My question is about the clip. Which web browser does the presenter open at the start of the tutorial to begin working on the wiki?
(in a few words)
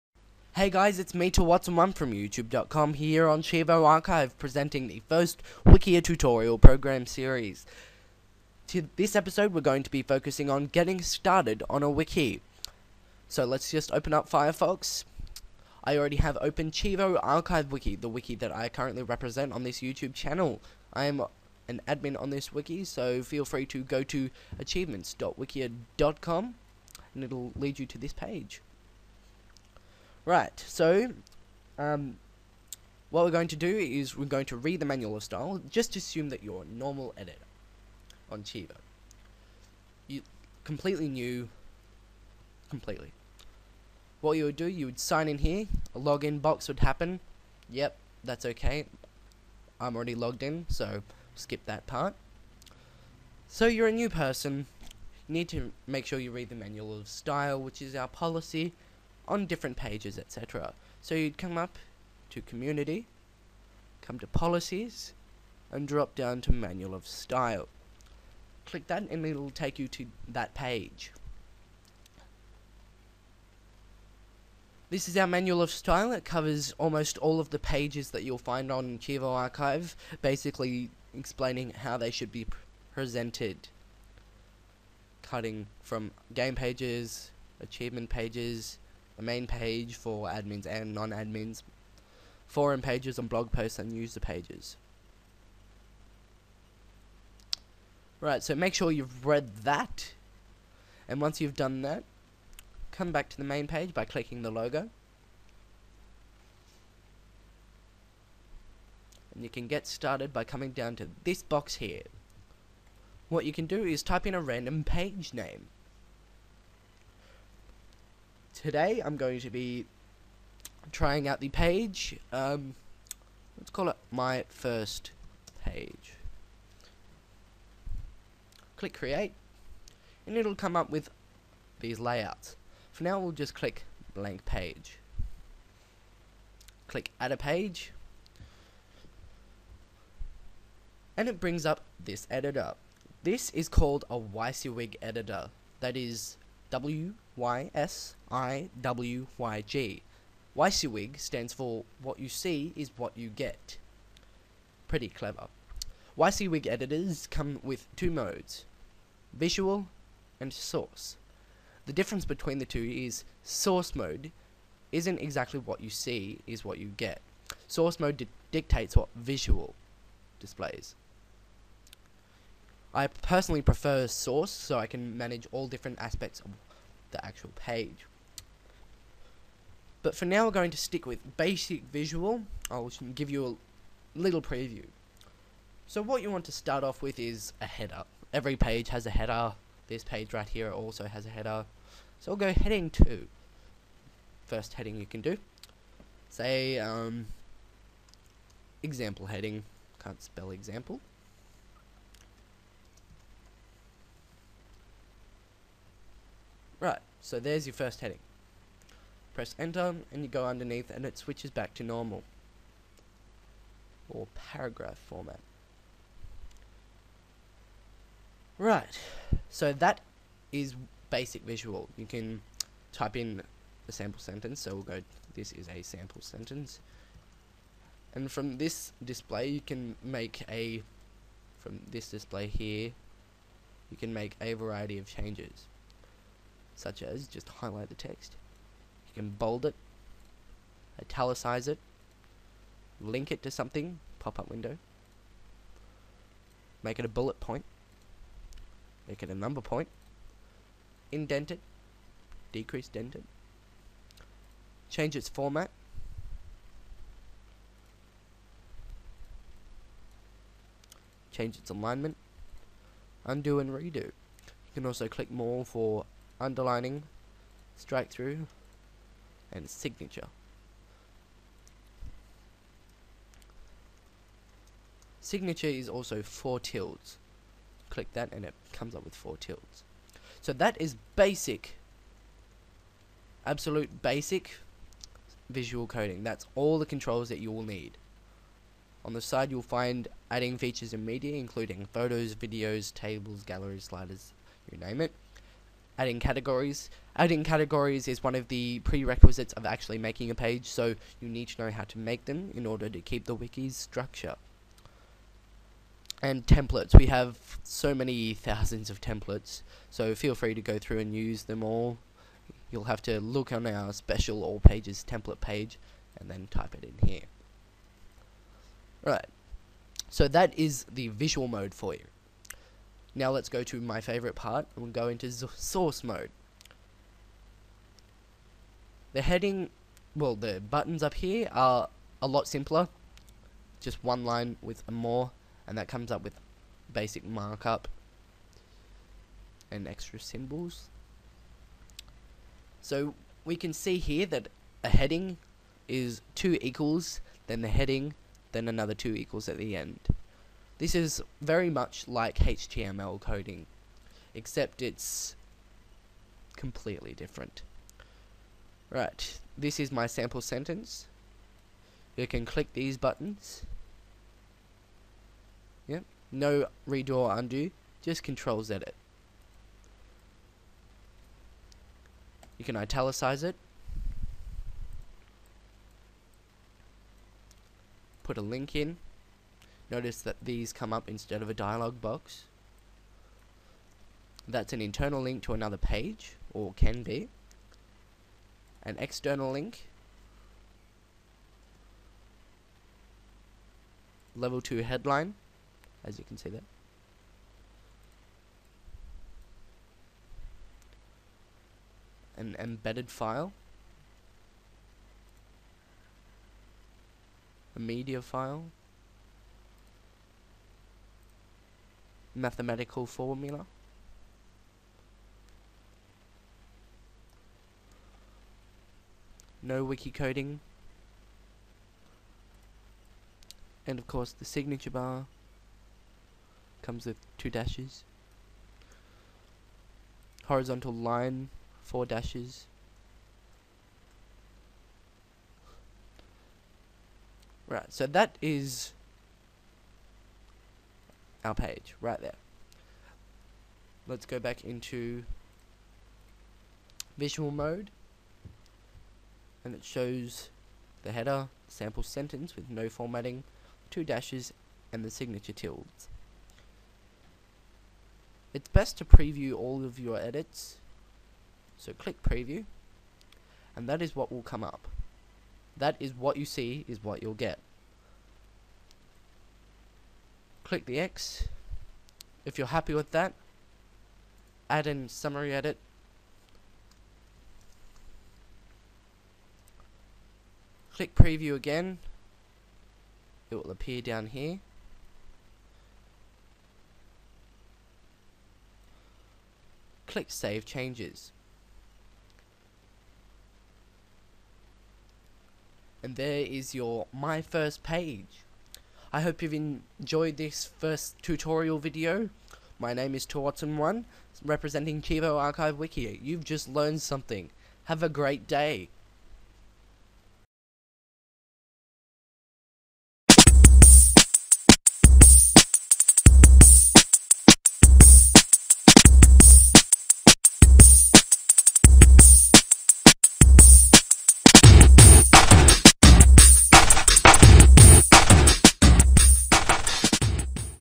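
Firefox.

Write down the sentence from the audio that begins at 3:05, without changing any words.
So what you want to start off with is a header.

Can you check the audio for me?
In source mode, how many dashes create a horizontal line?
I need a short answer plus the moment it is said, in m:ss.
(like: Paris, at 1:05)
4, at 7:11.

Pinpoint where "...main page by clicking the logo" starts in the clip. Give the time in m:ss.
1:43.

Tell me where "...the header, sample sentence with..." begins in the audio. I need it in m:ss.
7:31.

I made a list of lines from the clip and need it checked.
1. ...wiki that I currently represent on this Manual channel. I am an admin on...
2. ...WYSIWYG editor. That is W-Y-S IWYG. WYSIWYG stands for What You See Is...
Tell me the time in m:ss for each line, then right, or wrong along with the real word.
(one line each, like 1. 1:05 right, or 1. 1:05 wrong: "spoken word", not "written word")
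1. 0:18 wrong: "YouTube", not "Manual"
2. 2:24 right.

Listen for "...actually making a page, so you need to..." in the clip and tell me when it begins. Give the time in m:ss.
4:59.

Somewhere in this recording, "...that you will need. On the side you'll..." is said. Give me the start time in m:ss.
4:47.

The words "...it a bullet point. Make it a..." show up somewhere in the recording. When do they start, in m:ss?
4:06.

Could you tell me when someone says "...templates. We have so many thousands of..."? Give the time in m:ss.
5:06.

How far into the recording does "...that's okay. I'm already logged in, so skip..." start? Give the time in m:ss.
0:48.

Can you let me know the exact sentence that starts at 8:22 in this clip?
My name is Torotson1, representing Cheevo Archive Wiki.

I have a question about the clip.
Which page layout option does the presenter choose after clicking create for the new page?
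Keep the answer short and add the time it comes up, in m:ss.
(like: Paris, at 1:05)
blank page, at 2:14.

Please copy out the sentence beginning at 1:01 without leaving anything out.
So you'd come up to Community, come to Policies, and drop down to Manual of Style.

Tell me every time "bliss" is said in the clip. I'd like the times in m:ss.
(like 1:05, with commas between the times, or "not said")
not said.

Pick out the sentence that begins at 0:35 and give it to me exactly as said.
Just assume that you're a normal editor on Cheevo.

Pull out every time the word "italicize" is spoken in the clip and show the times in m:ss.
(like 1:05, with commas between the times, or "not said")
4:01, 6:12.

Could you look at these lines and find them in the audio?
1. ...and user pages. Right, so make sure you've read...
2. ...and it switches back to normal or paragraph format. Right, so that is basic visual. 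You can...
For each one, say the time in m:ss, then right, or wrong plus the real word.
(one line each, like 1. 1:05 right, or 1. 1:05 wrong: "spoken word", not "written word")
1. 1:33 right
2. 3:30 right.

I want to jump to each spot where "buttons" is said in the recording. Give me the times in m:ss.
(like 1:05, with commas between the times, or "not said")
5:30, 6:02.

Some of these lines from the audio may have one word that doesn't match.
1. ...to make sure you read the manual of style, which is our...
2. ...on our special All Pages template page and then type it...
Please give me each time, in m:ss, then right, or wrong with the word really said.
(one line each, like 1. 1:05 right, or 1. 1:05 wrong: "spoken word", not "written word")
1. 0:55 right
2. 5:13 right.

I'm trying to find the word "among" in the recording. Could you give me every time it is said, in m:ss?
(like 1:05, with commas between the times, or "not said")
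not said.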